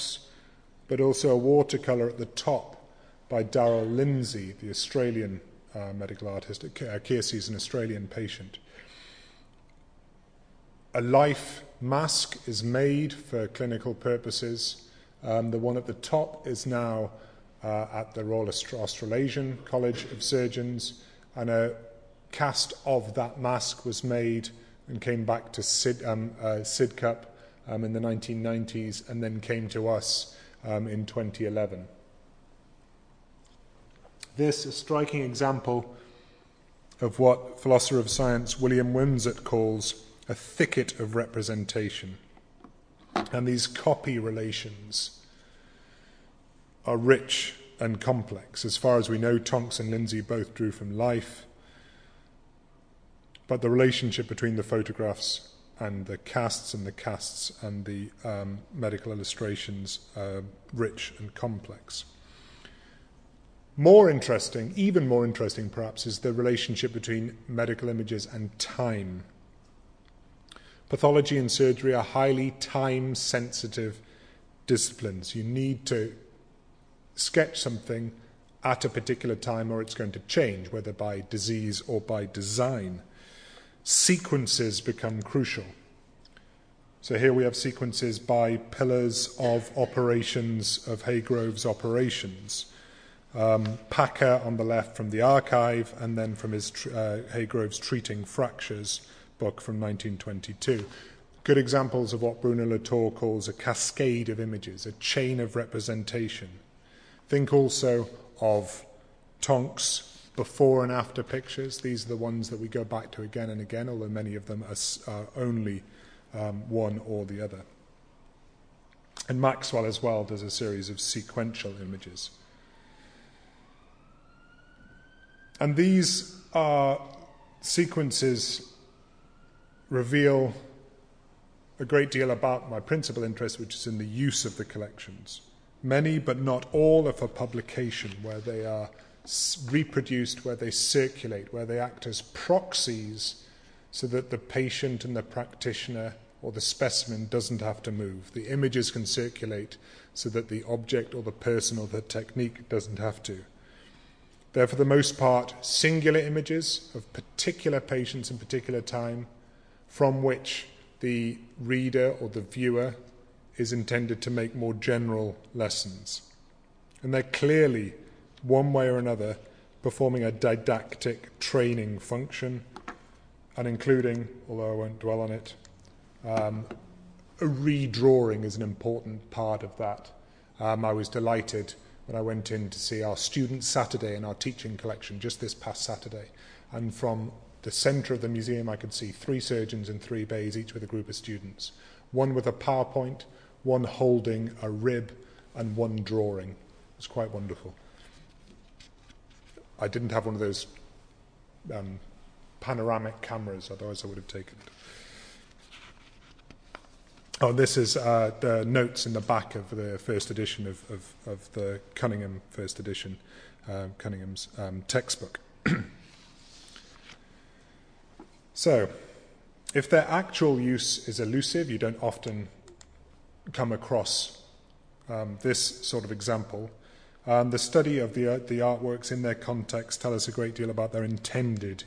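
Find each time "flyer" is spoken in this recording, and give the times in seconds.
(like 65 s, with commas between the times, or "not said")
not said.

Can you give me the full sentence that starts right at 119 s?
And Maxwell as well does a series of sequential images.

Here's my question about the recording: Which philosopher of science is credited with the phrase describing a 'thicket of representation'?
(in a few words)
William Wimsatt.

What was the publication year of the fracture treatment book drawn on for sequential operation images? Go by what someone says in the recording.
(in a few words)
1922.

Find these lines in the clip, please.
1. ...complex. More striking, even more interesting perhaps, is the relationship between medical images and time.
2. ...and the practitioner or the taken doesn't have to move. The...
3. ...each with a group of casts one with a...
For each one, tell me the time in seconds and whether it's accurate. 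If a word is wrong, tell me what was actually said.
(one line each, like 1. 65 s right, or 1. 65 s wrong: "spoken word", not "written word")
1. 61 s wrong: "interesting", not "striking"
2. 145 s wrong: "specimen", not "taken"
3. 190 s wrong: "students", not "casts".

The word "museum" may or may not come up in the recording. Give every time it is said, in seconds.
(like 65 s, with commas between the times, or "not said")
188 s.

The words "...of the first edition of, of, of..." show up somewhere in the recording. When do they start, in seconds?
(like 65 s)
209 s.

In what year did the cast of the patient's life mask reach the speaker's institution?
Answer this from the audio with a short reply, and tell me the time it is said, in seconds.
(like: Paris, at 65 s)
2011, at 31 s.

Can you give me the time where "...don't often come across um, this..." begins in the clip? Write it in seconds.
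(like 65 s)
221 s.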